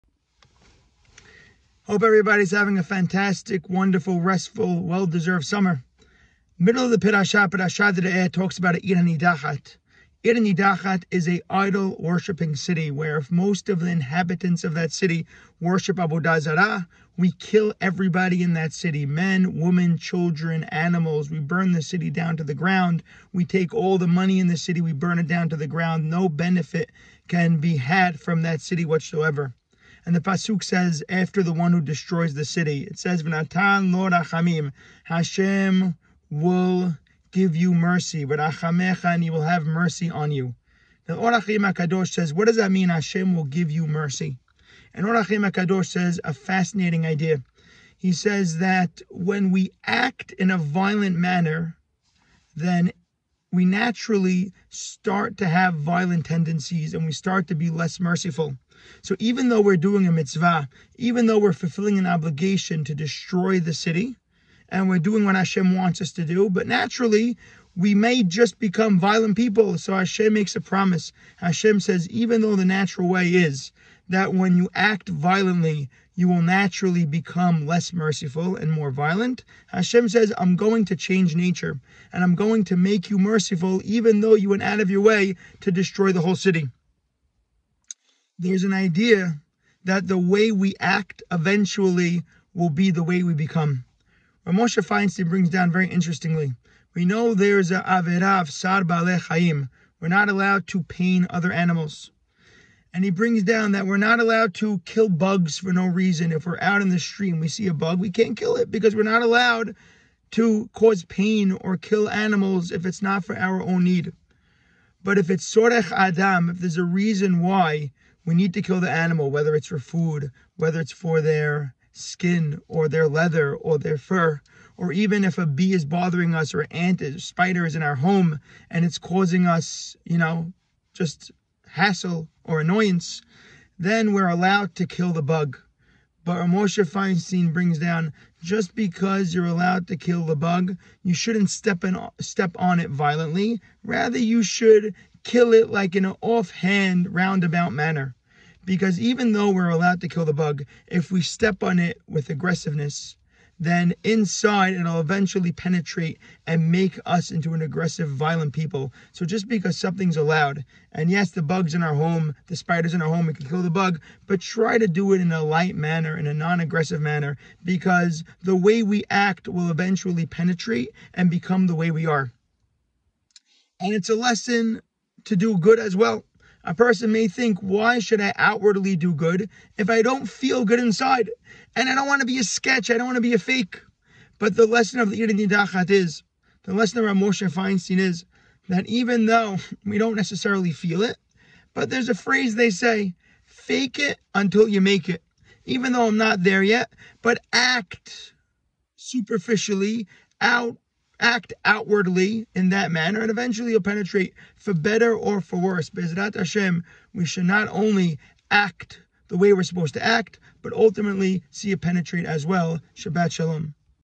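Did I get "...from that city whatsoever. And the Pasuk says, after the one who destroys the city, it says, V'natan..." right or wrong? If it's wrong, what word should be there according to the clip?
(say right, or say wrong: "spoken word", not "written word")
right.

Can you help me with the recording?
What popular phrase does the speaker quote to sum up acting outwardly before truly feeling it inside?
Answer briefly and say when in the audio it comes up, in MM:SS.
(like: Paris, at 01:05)
fake it until you make it, at 03:13.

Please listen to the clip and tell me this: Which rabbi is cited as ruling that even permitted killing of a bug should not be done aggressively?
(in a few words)
Rav Moshe Feinstein.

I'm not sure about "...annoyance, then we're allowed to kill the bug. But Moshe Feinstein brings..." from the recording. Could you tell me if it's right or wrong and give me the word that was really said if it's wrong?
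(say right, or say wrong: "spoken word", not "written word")
right.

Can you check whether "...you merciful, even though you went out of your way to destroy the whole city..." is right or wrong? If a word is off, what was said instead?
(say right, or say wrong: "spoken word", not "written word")
right.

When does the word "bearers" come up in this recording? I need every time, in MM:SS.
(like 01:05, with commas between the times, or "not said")
not said.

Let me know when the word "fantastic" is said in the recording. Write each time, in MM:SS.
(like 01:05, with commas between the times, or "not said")
00:02.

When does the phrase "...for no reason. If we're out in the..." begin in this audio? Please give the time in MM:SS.
01:45.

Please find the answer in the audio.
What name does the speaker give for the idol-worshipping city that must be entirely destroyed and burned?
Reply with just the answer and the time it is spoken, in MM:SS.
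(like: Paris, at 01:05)
Ir Nidachat, at 00:08.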